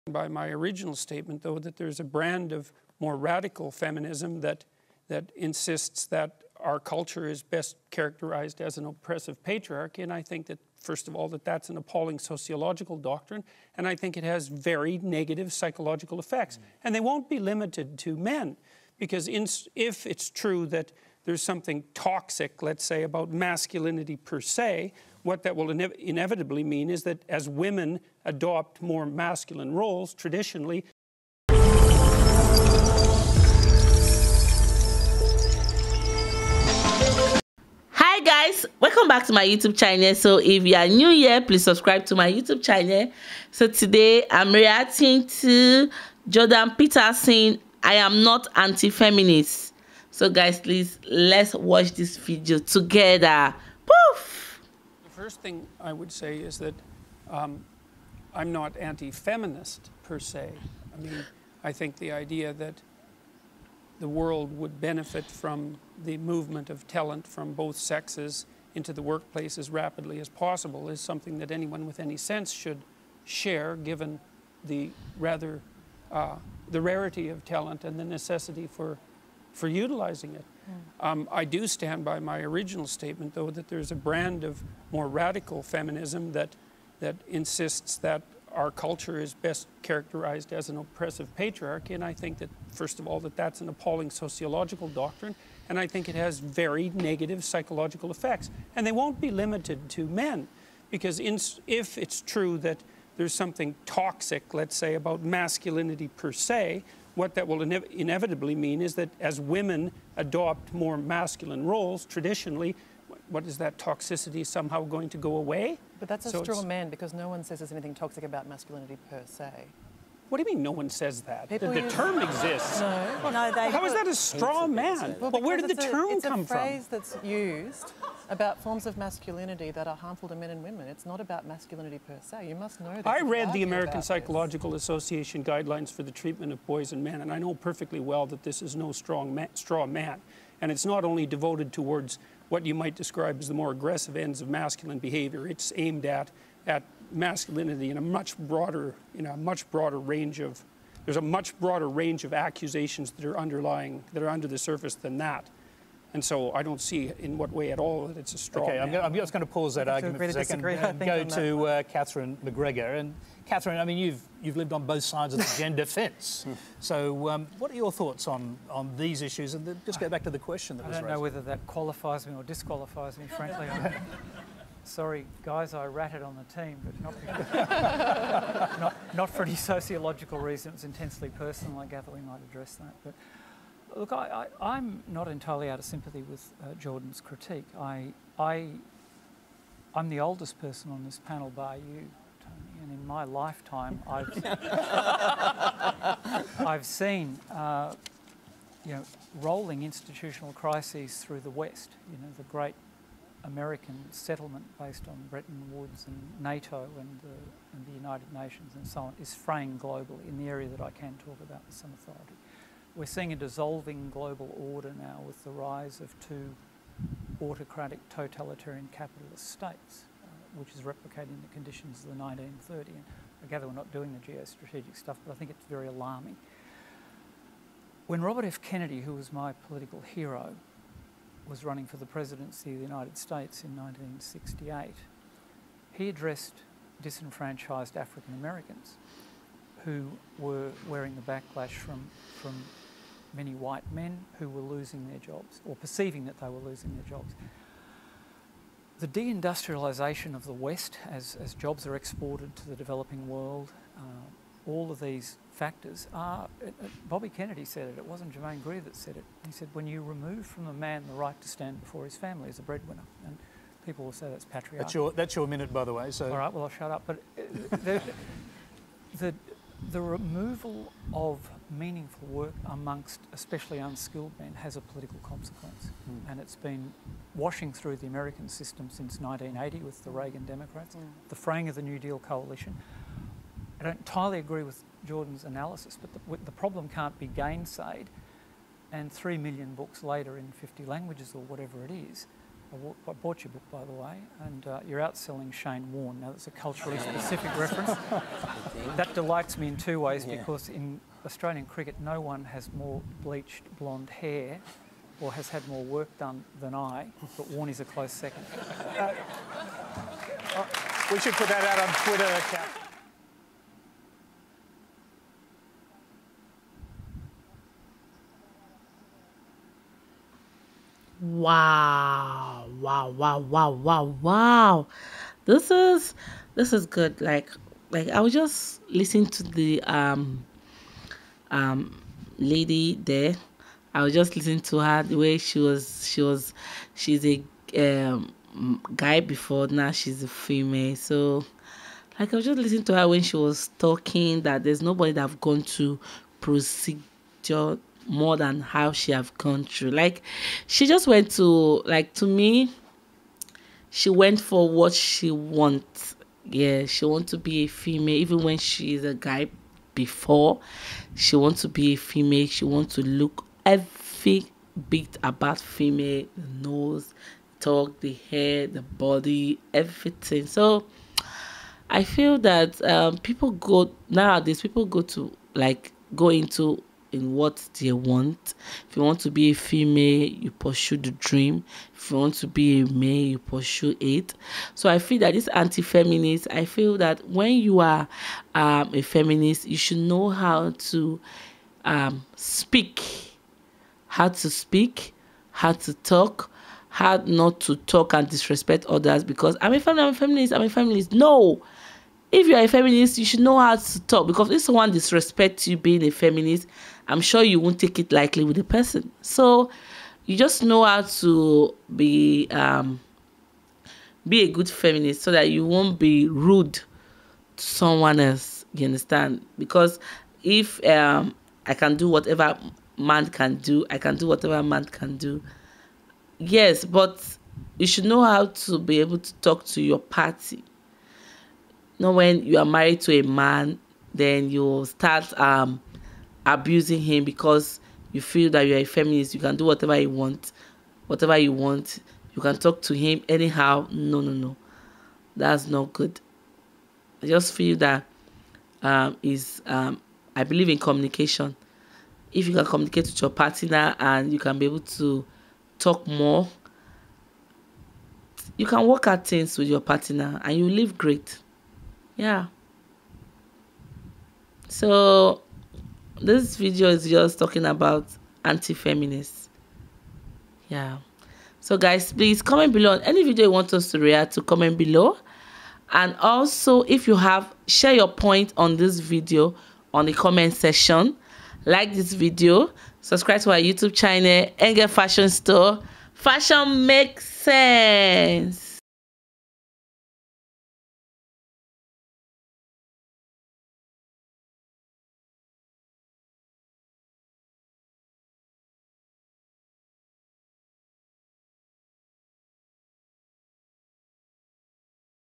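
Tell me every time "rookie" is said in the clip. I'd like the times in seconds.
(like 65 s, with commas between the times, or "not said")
not said.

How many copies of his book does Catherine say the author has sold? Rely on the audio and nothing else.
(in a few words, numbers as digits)
3 million.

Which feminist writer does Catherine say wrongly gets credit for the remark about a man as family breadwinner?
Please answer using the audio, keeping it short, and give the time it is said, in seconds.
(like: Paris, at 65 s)
Germaine Greer, at 258 s.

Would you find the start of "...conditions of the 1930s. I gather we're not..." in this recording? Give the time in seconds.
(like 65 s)
221 s.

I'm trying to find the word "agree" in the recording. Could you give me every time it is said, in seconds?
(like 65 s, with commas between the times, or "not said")
284 s.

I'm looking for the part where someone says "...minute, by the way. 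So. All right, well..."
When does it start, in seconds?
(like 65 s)
265 s.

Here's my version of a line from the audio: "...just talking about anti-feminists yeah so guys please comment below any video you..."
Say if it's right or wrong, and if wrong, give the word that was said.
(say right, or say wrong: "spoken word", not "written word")
right.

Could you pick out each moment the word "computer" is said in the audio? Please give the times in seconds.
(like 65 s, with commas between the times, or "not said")
not said.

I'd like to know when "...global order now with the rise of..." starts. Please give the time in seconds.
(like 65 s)
214 s.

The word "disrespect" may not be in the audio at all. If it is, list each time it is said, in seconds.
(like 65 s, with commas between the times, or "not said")
398 s, 404 s.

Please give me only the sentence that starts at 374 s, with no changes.
People go to like go into in what they want.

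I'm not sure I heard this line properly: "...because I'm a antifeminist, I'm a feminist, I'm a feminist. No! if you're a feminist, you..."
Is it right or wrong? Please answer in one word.
wrong.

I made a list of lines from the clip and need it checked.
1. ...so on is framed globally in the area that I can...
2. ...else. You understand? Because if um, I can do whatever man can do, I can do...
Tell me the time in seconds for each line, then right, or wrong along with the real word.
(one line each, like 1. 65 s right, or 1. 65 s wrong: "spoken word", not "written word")
1. 208 s right
2. 418 s right.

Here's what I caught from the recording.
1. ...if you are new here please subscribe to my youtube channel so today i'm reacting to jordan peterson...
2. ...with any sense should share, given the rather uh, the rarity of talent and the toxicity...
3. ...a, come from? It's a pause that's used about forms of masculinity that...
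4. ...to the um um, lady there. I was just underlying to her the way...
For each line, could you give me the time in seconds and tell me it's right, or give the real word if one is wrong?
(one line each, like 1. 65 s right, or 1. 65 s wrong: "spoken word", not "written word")
1. 40 s right
2. 71 s wrong: "necessity", not "toxicity"
3. 126 s wrong: "phrase", not "pause"
4. 329 s wrong: "listening", not "underlying".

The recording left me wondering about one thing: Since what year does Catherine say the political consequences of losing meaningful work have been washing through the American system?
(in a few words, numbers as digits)
1980.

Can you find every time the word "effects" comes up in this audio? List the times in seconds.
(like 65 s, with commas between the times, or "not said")
16 s, 98 s.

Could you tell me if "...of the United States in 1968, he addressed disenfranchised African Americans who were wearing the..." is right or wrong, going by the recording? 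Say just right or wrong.
right.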